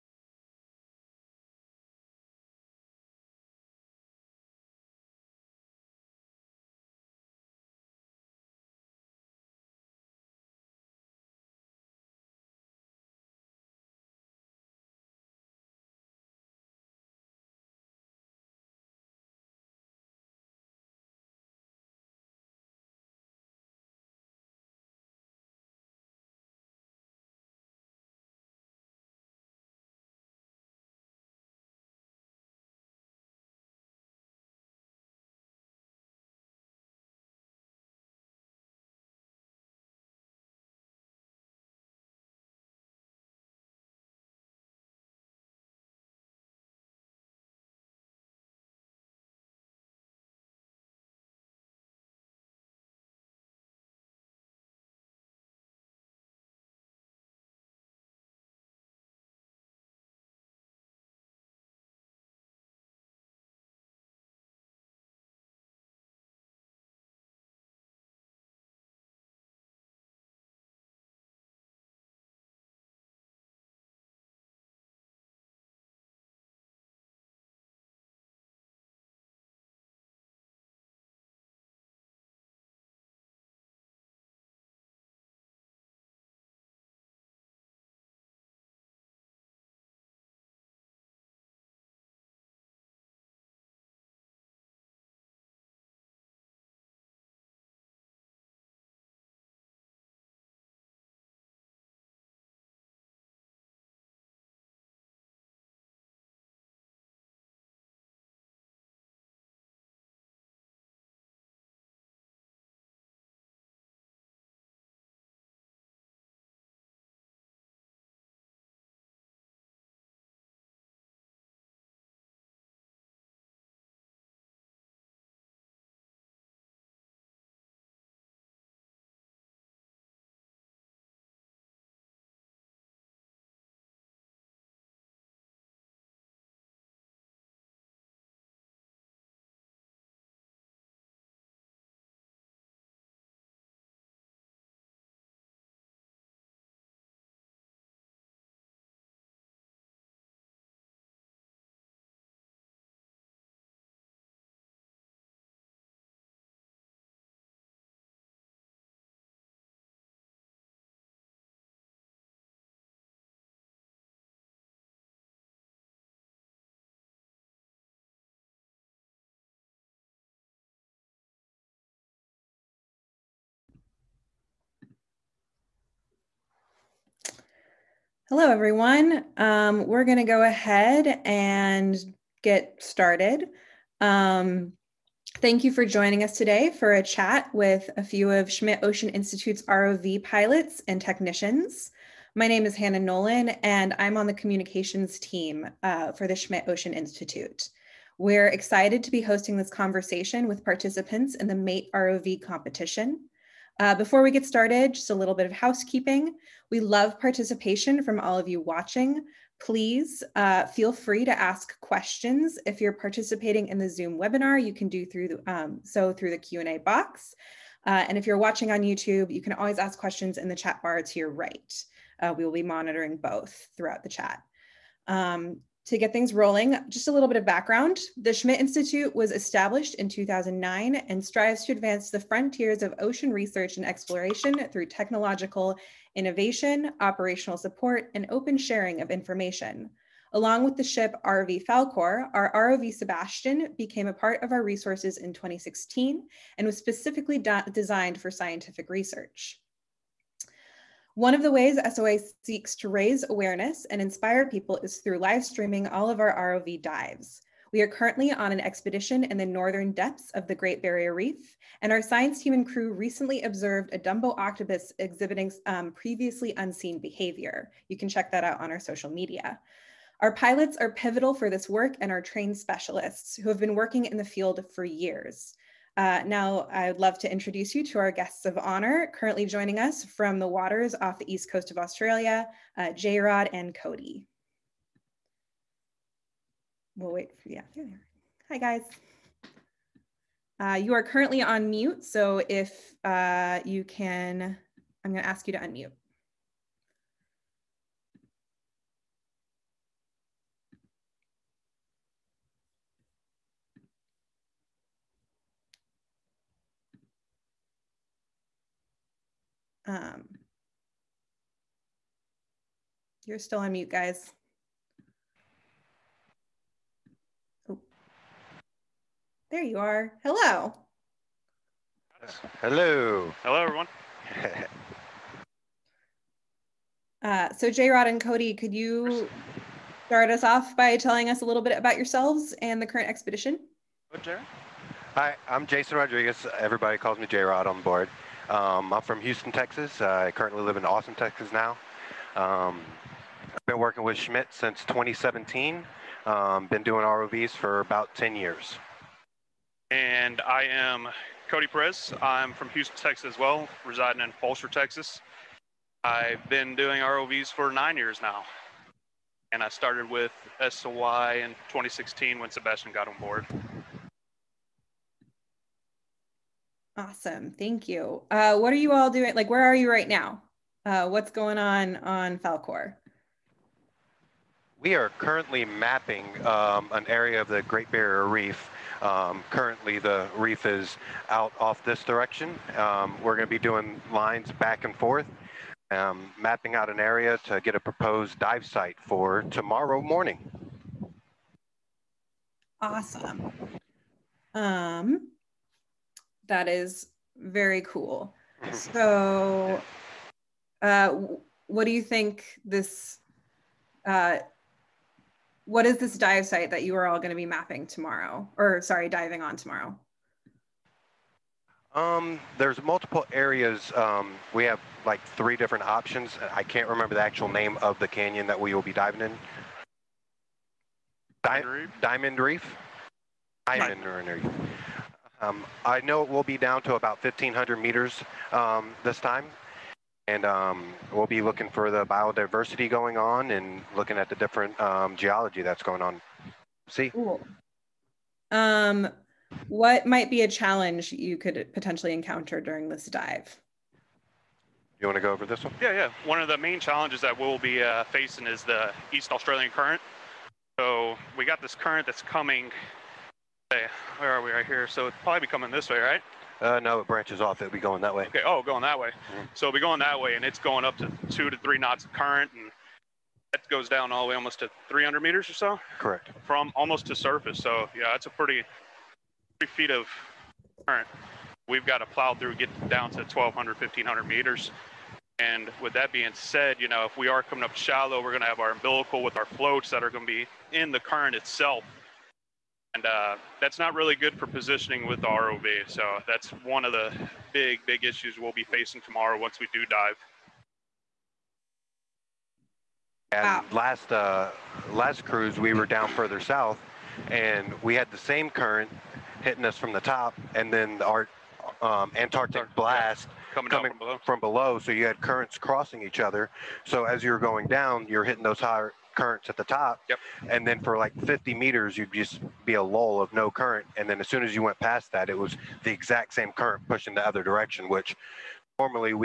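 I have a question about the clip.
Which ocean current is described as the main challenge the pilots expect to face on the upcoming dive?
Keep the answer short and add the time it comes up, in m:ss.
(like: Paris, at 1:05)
East Australian Current, at 7:29.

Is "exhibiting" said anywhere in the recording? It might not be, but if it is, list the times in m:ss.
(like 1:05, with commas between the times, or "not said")
4:25.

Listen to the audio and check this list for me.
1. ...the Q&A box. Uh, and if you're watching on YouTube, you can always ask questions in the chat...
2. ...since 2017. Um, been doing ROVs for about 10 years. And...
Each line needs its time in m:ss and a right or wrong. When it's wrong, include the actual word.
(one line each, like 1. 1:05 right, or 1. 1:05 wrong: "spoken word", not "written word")
1. 3:36 right
2. 5:44 right.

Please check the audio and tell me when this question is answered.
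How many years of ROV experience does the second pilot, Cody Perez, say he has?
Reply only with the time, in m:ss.
5:57.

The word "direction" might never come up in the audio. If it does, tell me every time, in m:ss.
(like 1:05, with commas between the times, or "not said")
6:22, 8:37.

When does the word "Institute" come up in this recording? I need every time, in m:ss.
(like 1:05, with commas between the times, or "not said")
3:09, 3:16, 3:48.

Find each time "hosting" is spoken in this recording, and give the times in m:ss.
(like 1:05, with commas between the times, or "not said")
3:19.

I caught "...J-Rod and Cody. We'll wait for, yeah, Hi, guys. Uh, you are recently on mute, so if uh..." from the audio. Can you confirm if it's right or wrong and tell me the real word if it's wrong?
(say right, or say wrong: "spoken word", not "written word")
wrong: "currently", not "recently".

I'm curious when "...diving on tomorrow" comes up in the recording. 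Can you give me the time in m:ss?
6:49.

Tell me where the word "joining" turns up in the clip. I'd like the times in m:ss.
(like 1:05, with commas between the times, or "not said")
3:05, 4:39.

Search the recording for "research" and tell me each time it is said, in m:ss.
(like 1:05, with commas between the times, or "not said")
3:53, 4:08.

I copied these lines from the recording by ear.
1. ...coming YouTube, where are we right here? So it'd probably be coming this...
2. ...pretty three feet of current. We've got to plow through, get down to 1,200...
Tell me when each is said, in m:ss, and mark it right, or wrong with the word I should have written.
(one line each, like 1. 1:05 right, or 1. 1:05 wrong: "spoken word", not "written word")
1. 7:32 wrong: "Hey", not "YouTube"
2. 7:48 right.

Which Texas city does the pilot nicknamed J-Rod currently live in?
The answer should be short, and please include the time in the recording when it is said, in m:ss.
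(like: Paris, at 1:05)
Austin, Texas, at 5:40.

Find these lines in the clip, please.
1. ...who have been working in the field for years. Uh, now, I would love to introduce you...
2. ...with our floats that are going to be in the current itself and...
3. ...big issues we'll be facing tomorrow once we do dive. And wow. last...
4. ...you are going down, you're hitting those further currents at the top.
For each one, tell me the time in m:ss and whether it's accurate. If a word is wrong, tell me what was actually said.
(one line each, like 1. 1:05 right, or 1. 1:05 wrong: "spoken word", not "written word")
1. 4:33 right
2. 7:59 right
3. 8:07 right
4. 8:27 wrong: "higher", not "further".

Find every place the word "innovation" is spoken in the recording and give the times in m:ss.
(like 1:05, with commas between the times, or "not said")
3:56.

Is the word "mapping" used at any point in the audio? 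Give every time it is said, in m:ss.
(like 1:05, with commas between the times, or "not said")
6:15, 6:26, 6:47.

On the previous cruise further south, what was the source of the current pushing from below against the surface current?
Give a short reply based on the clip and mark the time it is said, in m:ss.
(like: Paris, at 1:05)
Antarctic blast, at 8:22.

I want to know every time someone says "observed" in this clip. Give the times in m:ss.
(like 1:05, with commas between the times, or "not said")
4:23.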